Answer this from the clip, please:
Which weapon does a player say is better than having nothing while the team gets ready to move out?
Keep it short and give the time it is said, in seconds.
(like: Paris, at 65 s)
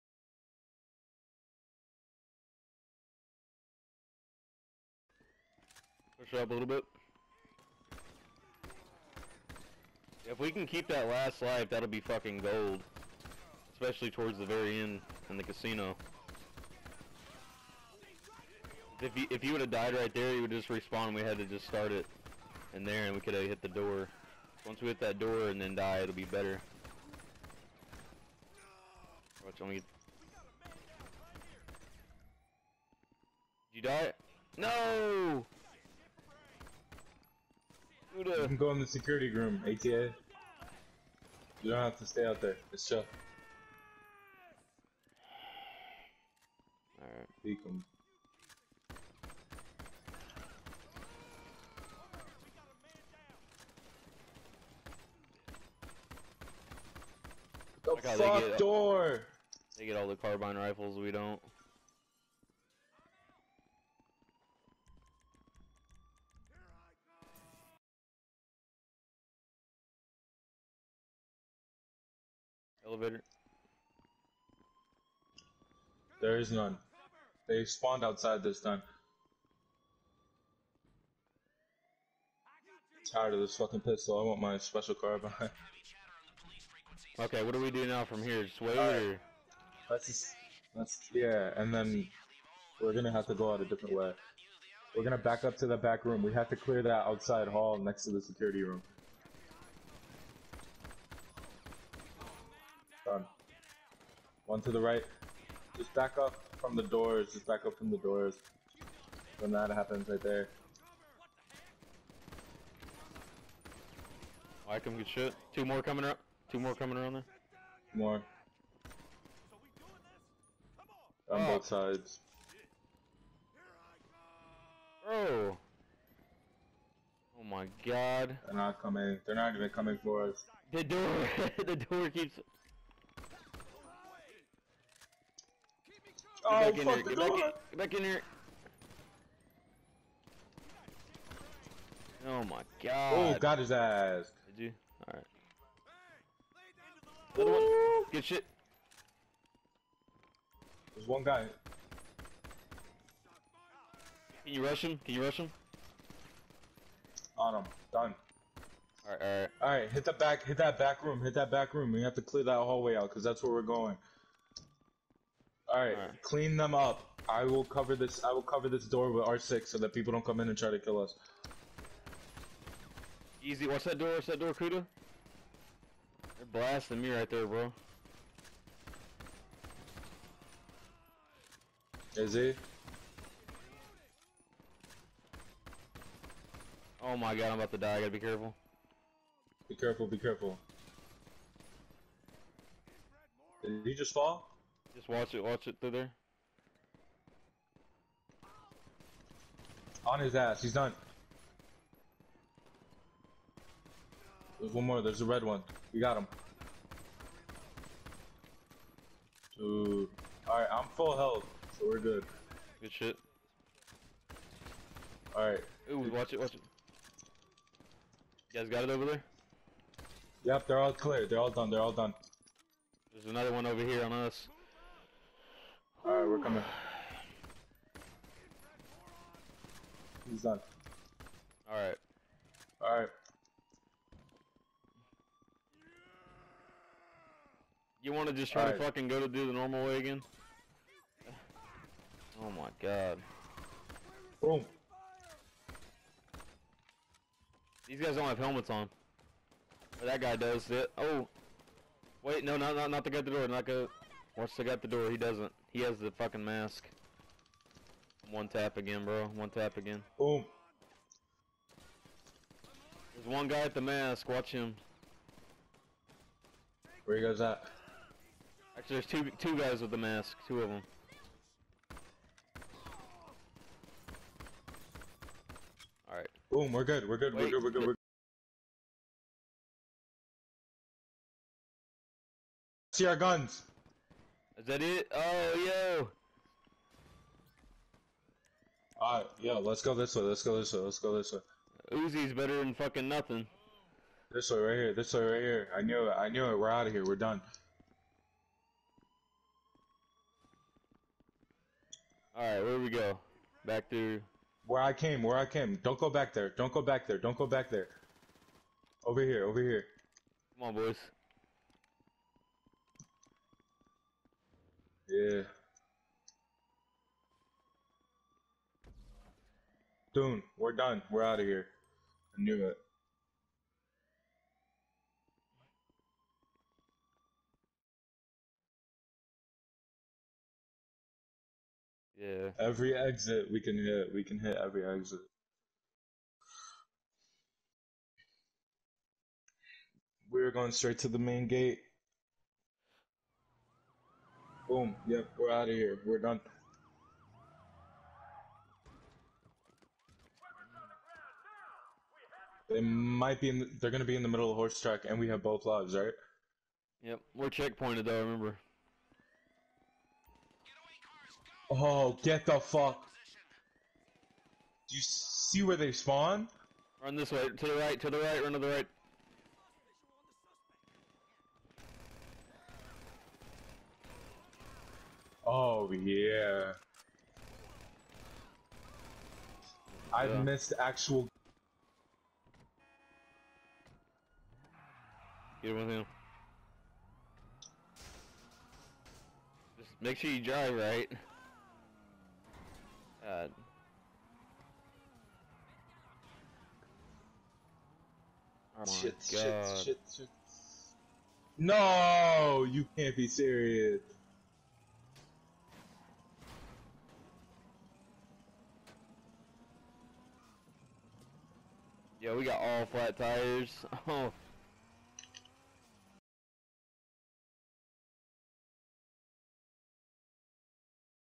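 Uzi, at 291 s.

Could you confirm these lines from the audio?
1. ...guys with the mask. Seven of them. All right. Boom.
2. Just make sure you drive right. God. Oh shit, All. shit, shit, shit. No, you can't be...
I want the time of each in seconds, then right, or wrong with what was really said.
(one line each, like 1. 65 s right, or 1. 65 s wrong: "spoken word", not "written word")
1. 269 s wrong: "Two", not "Seven"
2. 389 s wrong: "God", not "All".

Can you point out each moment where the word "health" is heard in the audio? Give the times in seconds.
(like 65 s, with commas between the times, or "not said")
211 s.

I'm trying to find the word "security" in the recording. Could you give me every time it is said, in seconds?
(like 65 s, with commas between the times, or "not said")
38 s, 98 s.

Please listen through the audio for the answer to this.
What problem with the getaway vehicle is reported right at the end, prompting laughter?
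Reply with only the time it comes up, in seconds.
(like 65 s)
412 s.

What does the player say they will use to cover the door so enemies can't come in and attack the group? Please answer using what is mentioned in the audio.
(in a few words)
R6.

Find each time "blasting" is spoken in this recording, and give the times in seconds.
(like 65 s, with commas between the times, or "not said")
176 s.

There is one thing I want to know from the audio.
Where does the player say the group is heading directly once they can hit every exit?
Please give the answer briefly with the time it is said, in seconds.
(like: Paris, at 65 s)
main gate, at 341 s.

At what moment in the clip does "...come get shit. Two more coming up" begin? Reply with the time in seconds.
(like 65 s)
114 s.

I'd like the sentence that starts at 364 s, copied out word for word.
Do you see where they spawn?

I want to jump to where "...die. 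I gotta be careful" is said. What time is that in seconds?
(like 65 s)
187 s.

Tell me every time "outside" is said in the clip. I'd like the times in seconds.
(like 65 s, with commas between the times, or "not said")
78 s, 97 s.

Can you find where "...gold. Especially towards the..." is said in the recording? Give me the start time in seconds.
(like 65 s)
12 s.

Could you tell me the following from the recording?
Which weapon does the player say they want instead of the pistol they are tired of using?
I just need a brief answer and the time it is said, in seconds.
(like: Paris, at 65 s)
special carbine, at 84 s.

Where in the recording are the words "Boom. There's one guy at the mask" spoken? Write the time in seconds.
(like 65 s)
260 s.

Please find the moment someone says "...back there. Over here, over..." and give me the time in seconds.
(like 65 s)
307 s.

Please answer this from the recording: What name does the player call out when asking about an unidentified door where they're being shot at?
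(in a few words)
Kuda.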